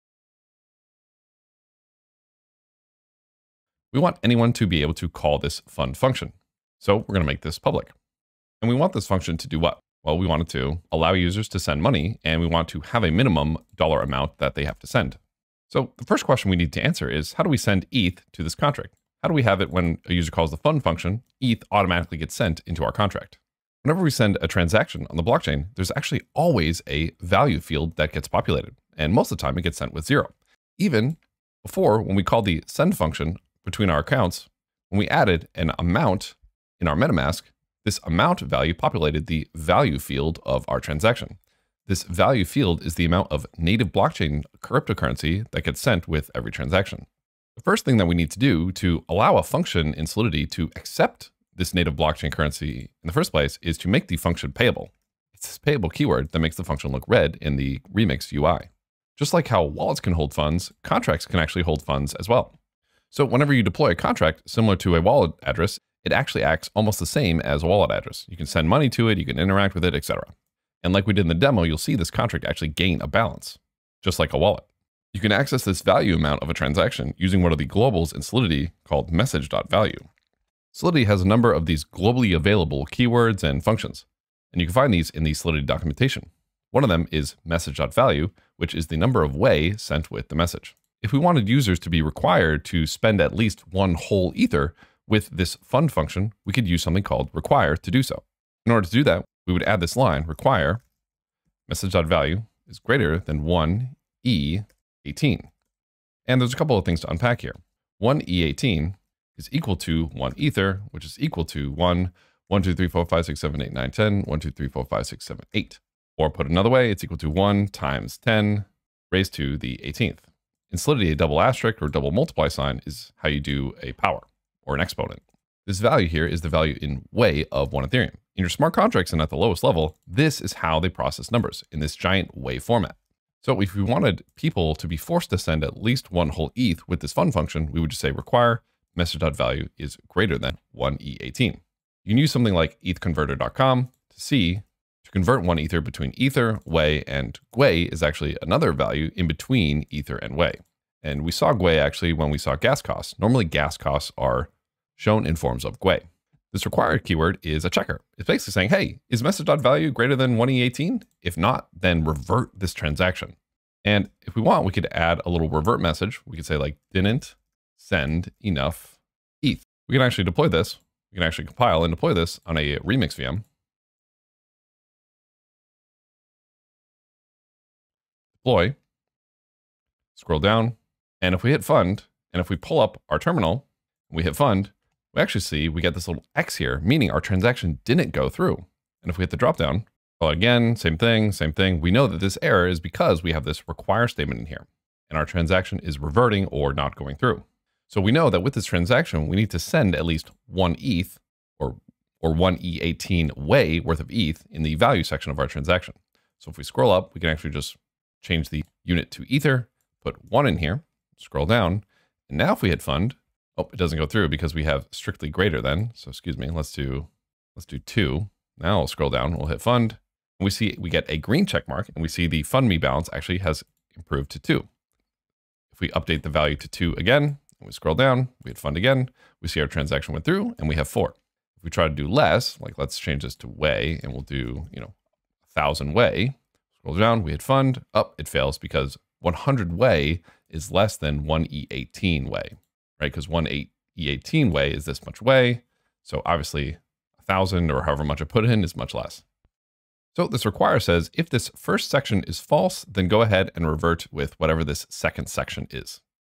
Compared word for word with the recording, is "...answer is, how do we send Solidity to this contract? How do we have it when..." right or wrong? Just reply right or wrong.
wrong.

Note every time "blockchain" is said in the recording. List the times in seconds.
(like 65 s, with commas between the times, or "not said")
25 s, 43 s, 51 s.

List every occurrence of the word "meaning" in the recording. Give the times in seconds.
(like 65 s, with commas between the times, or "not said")
186 s.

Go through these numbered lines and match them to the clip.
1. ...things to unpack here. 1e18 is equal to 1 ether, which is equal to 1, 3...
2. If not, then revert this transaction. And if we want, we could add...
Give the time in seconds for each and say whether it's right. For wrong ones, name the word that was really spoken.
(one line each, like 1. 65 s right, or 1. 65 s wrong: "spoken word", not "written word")
1. 106 s wrong: "1", not "3"
2. 161 s right.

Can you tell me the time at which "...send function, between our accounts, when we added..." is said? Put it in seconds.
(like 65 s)
32 s.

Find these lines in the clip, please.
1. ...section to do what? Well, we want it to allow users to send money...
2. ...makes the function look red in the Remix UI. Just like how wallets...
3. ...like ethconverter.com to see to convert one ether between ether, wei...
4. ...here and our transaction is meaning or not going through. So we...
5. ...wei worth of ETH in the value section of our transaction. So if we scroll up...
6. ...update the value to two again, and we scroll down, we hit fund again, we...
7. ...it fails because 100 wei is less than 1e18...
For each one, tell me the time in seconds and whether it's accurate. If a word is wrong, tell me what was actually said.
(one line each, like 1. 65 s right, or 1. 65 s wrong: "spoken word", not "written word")
1. 9 s wrong: "function", not "section"
2. 56 s right
3. 142 s right
4. 194 s wrong: "reverting", not "meaning"
5. 203 s right
6. 225 s right
7. 238 s right.